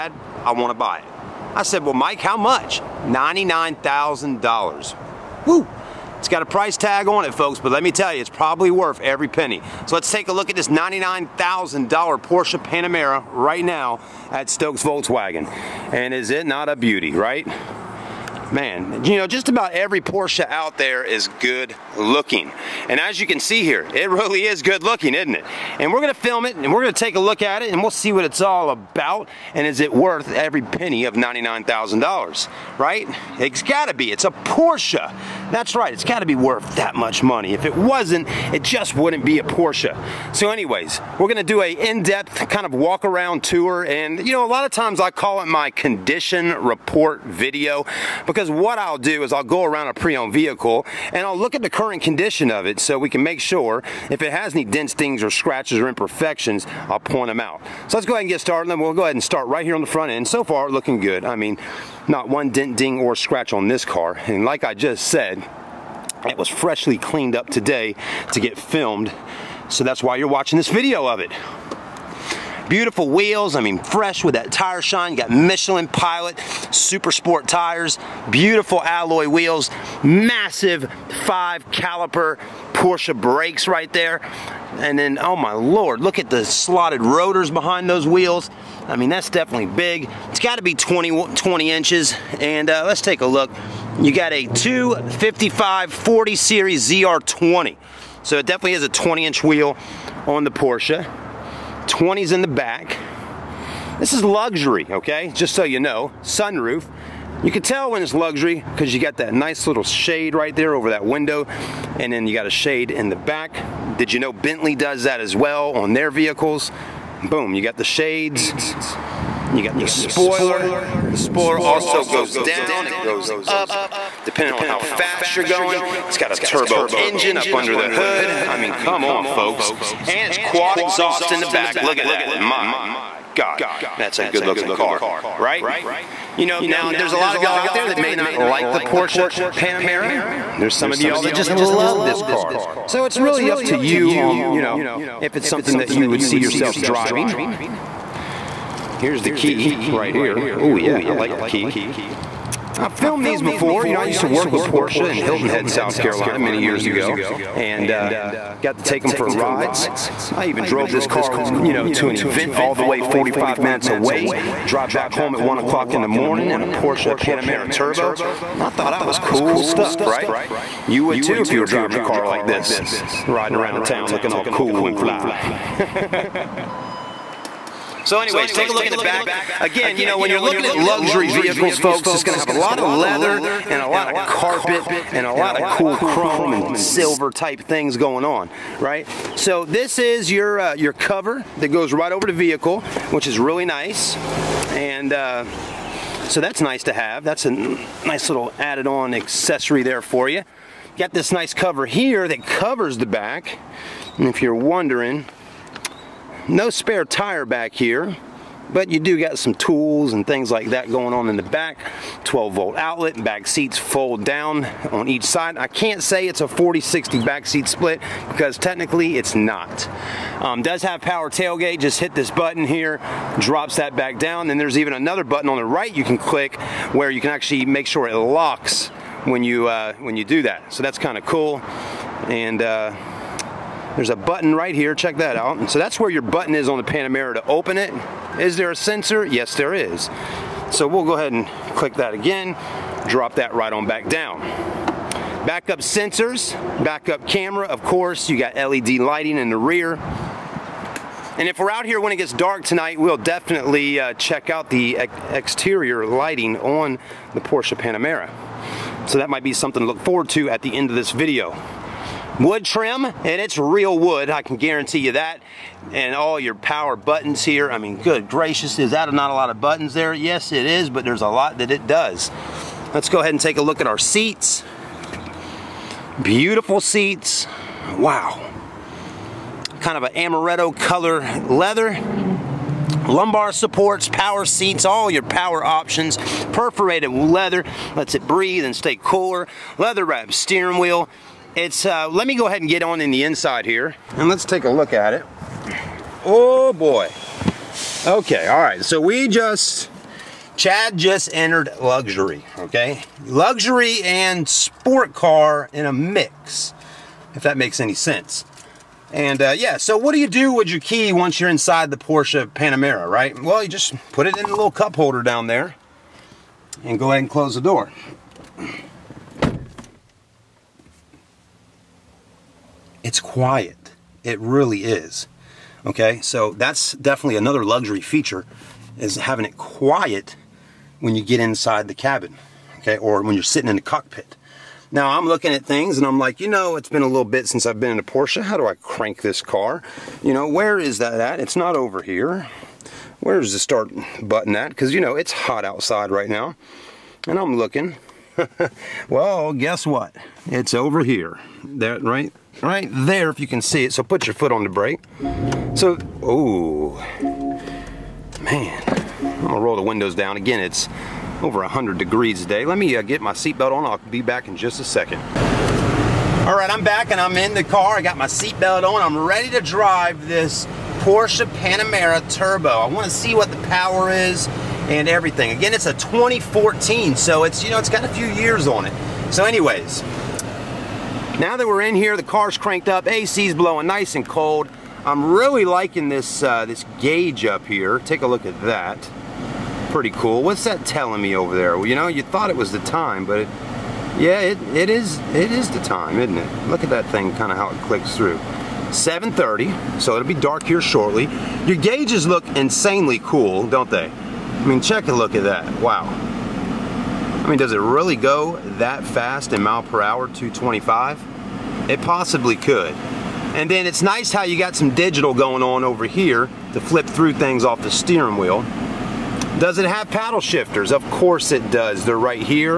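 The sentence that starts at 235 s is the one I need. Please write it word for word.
So that's where your button is on the Panamera to open it.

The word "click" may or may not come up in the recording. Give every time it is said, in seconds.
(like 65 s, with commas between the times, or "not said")
226 s, 241 s, 397 s.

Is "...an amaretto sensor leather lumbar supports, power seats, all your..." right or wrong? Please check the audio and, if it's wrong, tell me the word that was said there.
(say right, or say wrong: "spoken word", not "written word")
wrong: "color", not "sensor".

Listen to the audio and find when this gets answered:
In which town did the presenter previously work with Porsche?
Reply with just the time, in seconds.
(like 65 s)
155 s.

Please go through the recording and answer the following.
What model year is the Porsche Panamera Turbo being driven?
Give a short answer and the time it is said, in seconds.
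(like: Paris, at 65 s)
2014, at 375 s.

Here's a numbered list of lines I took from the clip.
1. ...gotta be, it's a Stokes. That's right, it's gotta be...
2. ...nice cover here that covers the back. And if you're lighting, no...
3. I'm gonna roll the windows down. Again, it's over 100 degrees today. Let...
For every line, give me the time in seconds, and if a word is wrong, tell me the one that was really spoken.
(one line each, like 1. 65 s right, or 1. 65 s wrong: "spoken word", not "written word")
1. 33 s wrong: "Porsche", not "Stokes"
2. 201 s wrong: "wondering", not "lighting"
3. 359 s right.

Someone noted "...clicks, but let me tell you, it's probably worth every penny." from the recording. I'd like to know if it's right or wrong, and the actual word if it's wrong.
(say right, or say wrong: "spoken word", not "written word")
wrong: "folks", not "clicks".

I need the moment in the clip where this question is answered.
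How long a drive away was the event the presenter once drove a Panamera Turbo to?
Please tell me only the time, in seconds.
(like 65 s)
163 s.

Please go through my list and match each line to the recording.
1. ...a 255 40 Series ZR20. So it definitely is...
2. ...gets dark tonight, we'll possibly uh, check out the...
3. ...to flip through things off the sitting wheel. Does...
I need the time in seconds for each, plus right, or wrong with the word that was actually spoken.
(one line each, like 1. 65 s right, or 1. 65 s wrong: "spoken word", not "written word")
1. 94 s right
2. 252 s wrong: "definitely", not "possibly"
3. 416 s wrong: "steering", not "sitting".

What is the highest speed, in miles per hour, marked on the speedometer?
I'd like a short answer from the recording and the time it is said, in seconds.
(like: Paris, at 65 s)
225, at 410 s.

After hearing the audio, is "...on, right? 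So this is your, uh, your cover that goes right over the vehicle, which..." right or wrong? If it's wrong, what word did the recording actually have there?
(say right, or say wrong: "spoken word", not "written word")
right.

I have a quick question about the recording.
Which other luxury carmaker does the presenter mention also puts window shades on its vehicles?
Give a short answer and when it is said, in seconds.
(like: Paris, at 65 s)
Bentley, at 114 s.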